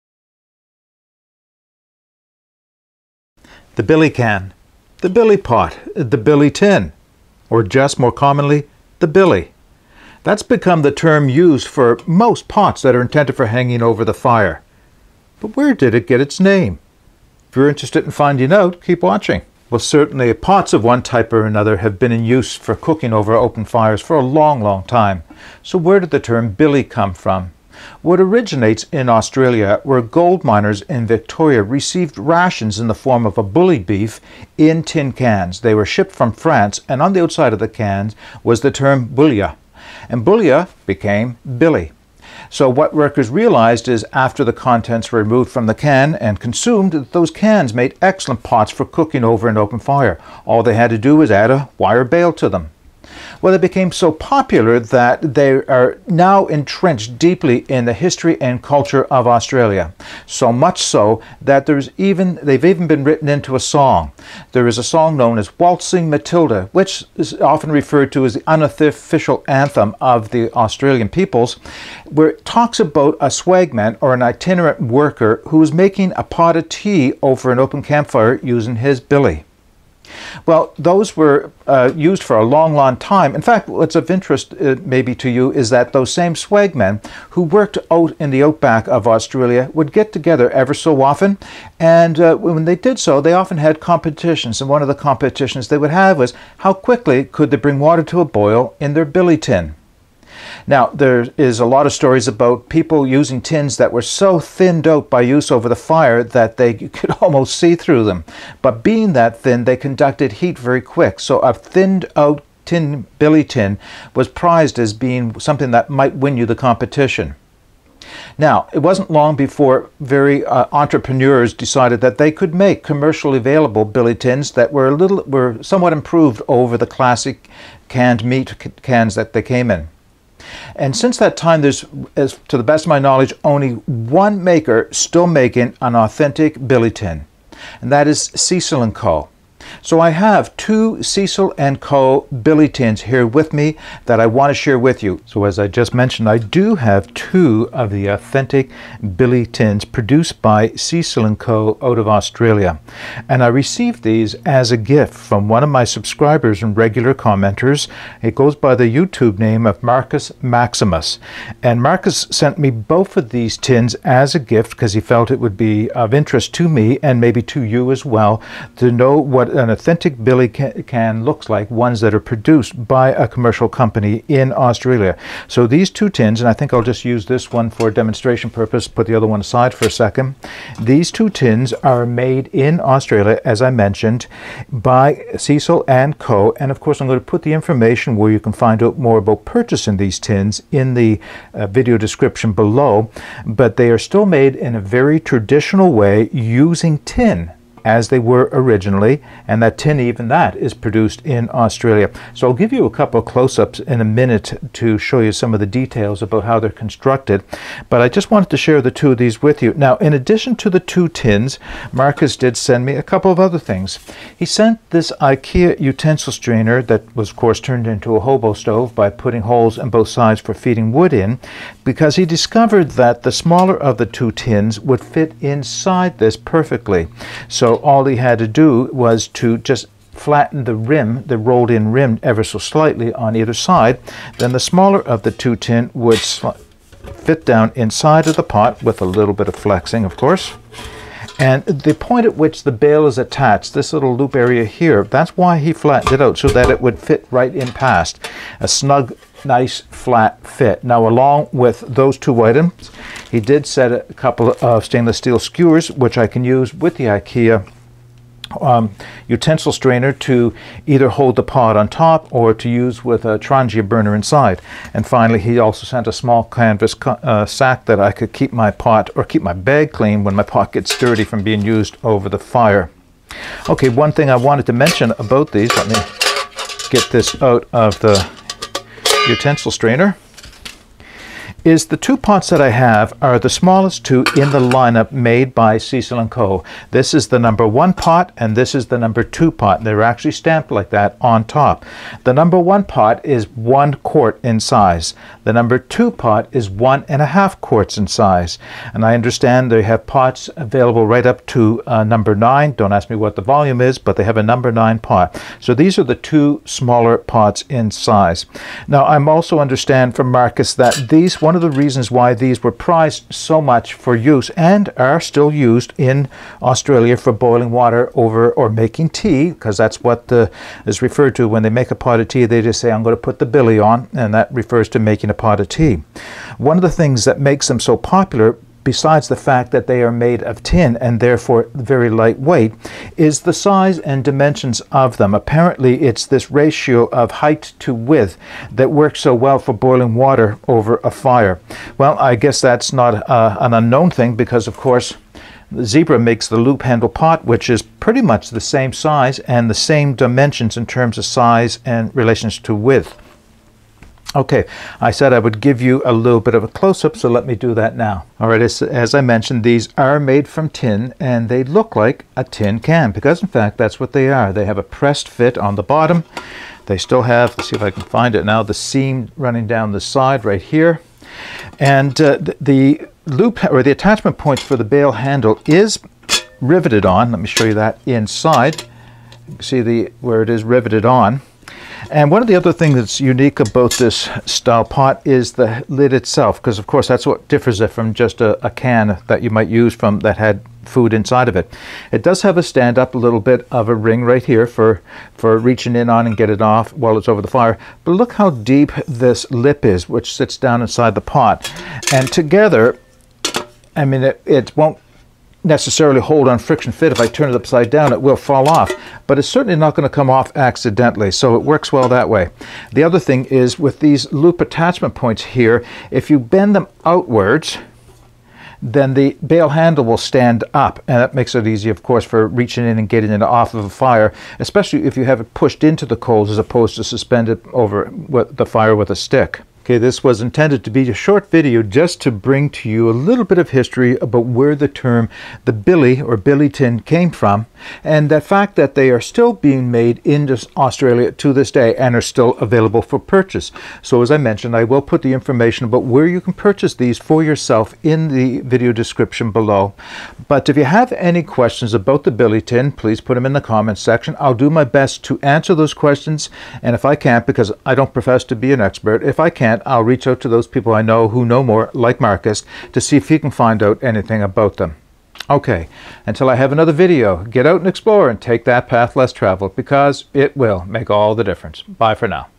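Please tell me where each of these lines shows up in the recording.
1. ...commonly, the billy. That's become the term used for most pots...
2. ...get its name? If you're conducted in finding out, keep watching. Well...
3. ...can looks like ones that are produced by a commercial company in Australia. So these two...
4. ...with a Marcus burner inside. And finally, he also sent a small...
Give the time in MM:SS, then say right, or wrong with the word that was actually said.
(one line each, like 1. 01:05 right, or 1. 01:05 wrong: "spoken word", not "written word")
1. 00:08 right
2. 00:16 wrong: "interested", not "conducted"
3. 02:50 right
4. 04:23 wrong: "Trangia", not "Marcus".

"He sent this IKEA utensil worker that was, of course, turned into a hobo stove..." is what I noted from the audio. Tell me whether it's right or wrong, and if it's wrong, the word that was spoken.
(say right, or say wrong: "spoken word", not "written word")
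wrong: "strainer", not "worker".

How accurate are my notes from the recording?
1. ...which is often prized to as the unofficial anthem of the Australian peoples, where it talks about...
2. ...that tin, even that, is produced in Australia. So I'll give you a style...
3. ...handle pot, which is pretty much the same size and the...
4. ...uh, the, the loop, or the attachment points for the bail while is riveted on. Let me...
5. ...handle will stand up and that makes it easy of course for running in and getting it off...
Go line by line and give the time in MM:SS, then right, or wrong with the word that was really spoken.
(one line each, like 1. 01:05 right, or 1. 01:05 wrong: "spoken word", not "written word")
1. 01:06 wrong: "referred", not "prized"
2. 03:19 wrong: "couple", not "style"
3. 05:46 right
4. 06:12 wrong: "handle", not "while"
5. 06:59 wrong: "reaching", not "running".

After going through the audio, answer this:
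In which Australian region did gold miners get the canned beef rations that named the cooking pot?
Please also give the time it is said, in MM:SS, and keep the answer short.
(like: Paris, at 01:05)
Victoria, at 00:31.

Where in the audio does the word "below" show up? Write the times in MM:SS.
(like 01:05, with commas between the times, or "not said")
03:12, 07:29.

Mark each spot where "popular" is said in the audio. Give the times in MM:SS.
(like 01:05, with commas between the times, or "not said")
00:54, 05:27.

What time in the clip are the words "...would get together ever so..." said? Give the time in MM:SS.
01:29.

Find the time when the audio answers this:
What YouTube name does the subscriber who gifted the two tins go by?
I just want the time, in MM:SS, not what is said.
02:39.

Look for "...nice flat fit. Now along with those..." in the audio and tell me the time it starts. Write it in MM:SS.
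04:09.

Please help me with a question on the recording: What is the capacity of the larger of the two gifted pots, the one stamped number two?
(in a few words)
1.5 quarts.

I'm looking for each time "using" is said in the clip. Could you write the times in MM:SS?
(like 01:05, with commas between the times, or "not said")
01:18, 01:43, 03:16.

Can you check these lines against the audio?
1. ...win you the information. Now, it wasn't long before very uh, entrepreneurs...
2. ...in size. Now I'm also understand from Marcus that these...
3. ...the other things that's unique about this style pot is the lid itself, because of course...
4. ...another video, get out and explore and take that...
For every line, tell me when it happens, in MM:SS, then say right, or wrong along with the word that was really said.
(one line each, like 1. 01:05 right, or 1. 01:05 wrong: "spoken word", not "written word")
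1. 01:56 wrong: "competition", not "information"
2. 05:07 right
3. 06:22 right
4. 07:46 right.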